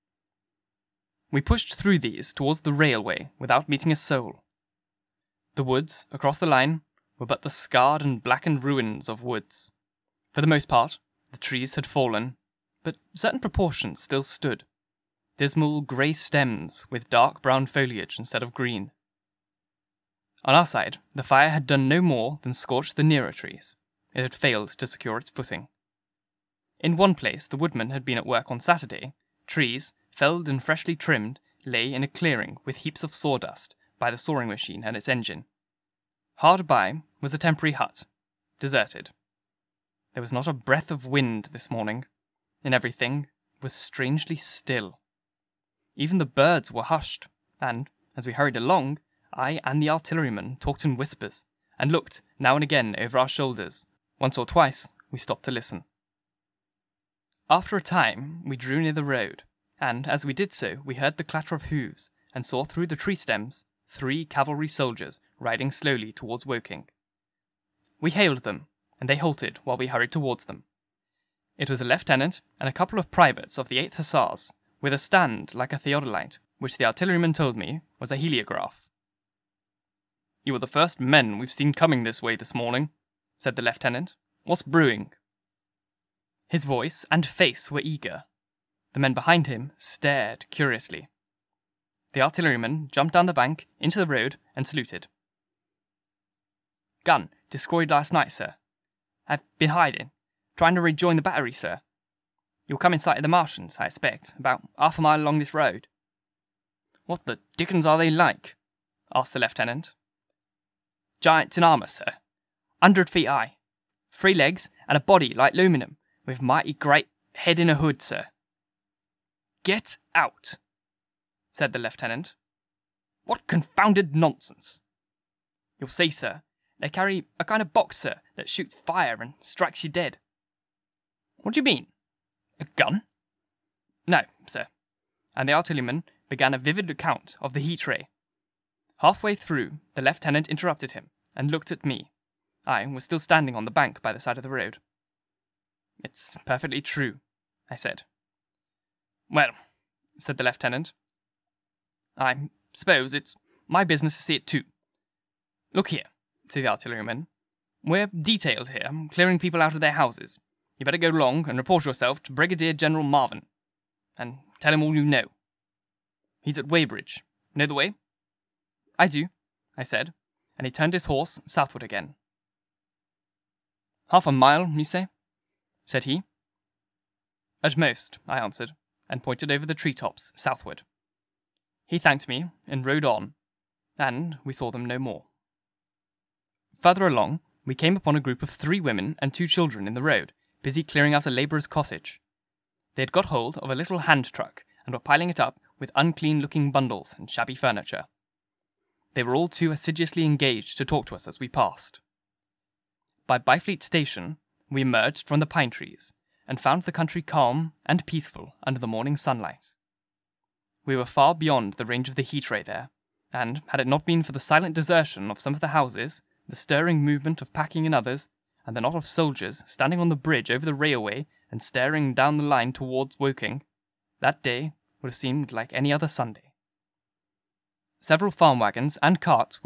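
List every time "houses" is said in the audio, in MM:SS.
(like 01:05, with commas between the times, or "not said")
02:39, 03:35.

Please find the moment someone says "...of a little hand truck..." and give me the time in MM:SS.
03:13.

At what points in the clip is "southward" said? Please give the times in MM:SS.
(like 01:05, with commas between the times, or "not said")
02:51, 03:00.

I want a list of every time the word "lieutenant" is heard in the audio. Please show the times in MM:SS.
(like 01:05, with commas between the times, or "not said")
01:11, 01:23, 01:49, 02:01, 02:20, 02:30.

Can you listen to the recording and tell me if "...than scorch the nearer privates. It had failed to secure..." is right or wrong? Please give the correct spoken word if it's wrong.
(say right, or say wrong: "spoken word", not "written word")
wrong: "trees", not "privates".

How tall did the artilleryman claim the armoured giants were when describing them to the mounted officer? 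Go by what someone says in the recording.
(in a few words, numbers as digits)
100 feet.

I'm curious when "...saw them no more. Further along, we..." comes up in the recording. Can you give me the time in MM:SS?
03:04.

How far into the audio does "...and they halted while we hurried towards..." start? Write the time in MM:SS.
01:08.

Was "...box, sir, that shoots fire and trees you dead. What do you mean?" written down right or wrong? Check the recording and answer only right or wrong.
wrong.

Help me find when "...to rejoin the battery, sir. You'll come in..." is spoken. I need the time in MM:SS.
01:40.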